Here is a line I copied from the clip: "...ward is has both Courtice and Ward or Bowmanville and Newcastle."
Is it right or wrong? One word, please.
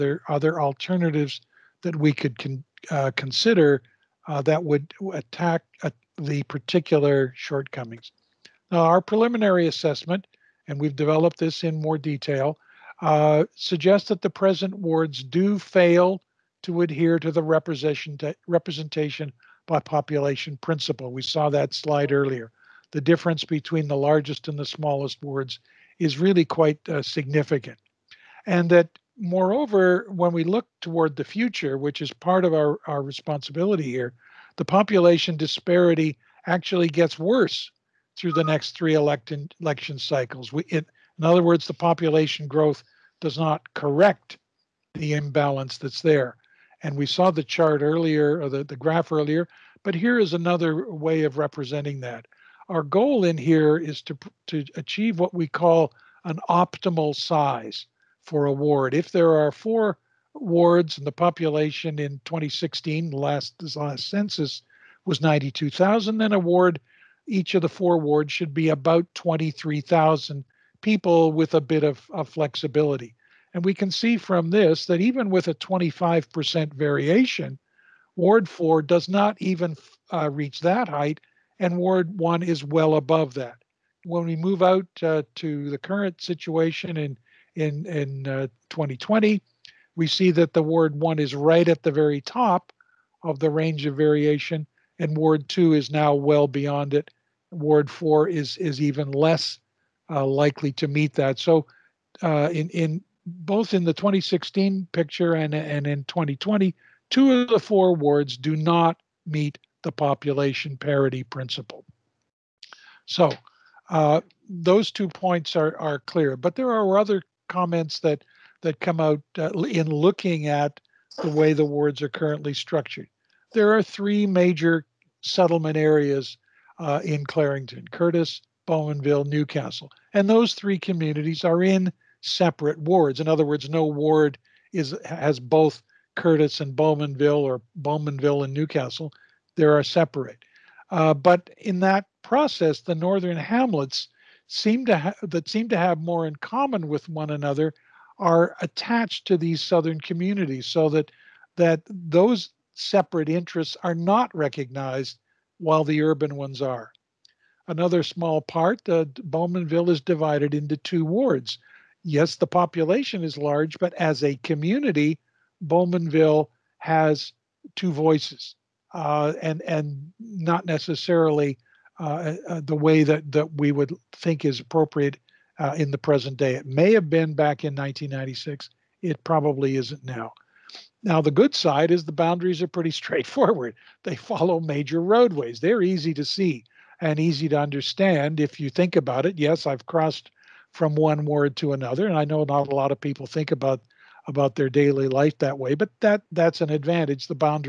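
wrong.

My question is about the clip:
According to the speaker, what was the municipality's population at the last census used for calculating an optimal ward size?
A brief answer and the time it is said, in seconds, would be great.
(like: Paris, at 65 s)
92,000, at 65 s.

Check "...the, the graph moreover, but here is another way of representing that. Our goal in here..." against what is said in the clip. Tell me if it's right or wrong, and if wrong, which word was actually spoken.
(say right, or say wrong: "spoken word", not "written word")
wrong: "earlier", not "moreover".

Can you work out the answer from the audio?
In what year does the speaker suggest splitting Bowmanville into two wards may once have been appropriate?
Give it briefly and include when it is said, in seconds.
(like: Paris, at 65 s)
1996, at 177 s.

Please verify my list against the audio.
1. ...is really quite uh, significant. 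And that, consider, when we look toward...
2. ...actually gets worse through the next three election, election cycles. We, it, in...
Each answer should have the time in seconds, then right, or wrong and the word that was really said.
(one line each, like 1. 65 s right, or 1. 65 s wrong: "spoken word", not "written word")
1. 25 s wrong: "moreover", not "consider"
2. 36 s right.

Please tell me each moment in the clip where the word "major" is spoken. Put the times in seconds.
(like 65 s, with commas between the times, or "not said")
124 s, 184 s.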